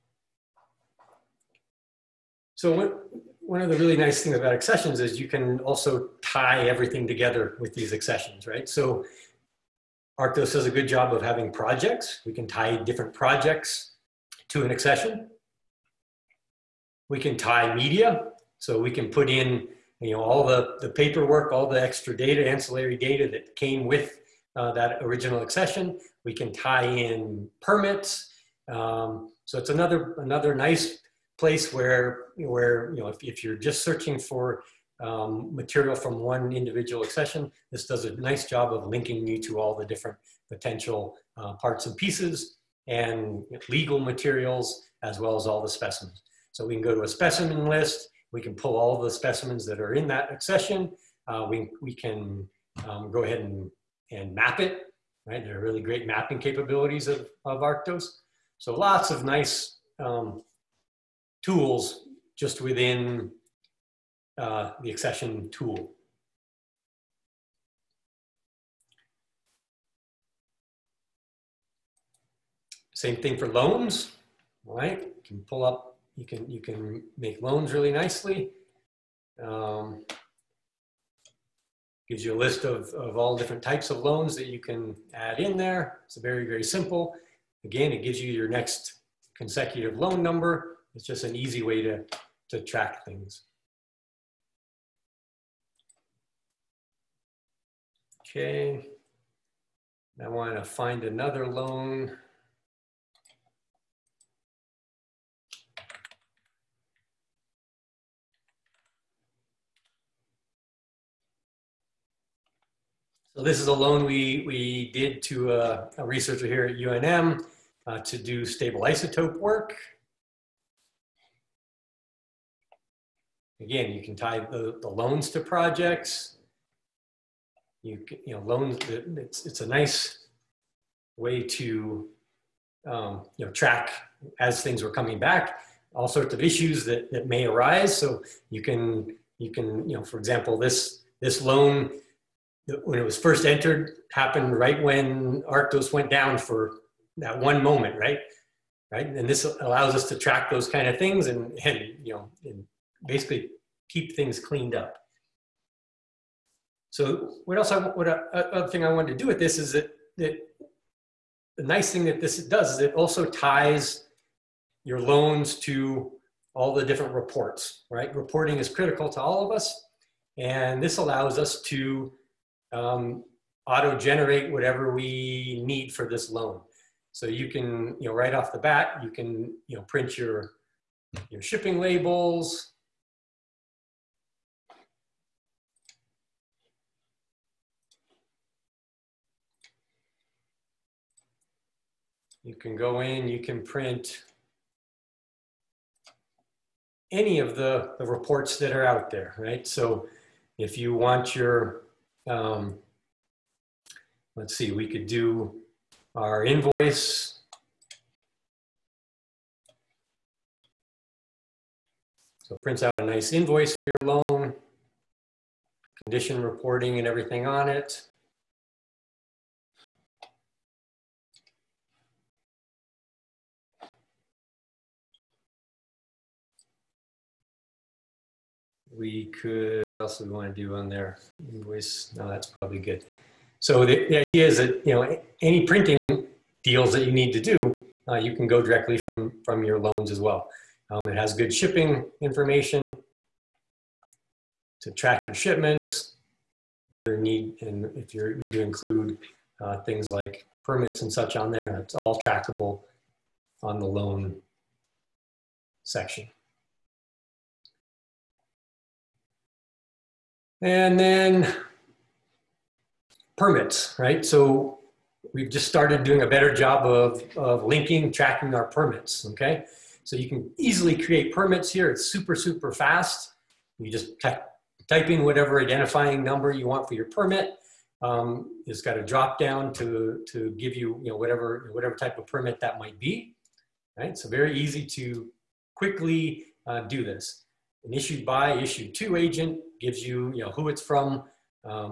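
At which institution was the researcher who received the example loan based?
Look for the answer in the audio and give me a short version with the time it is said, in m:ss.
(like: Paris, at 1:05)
UNM, at 1:56.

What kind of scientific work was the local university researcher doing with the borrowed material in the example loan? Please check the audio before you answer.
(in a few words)
stable isotope work.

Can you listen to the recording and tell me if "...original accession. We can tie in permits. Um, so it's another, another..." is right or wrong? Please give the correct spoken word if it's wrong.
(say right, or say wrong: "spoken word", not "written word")
right.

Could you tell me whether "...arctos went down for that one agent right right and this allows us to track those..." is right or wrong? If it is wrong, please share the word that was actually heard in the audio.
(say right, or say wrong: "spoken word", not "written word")
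wrong: "moment", not "agent".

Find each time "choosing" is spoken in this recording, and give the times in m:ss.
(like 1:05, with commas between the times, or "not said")
not said.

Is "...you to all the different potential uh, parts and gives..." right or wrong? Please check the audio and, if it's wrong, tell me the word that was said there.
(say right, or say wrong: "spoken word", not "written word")
wrong: "pieces", not "gives".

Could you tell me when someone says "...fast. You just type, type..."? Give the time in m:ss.
4:32.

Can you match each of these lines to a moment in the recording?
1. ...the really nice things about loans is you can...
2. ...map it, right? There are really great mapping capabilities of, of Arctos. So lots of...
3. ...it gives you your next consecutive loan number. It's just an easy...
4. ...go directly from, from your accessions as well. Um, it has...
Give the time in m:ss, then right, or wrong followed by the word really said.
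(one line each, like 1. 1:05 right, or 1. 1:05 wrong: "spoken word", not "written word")
1. 0:03 wrong: "accessions", not "loans"
2. 0:54 right
3. 1:27 right
4. 3:58 wrong: "loans", not "accessions".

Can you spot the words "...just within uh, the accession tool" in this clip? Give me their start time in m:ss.
1:02.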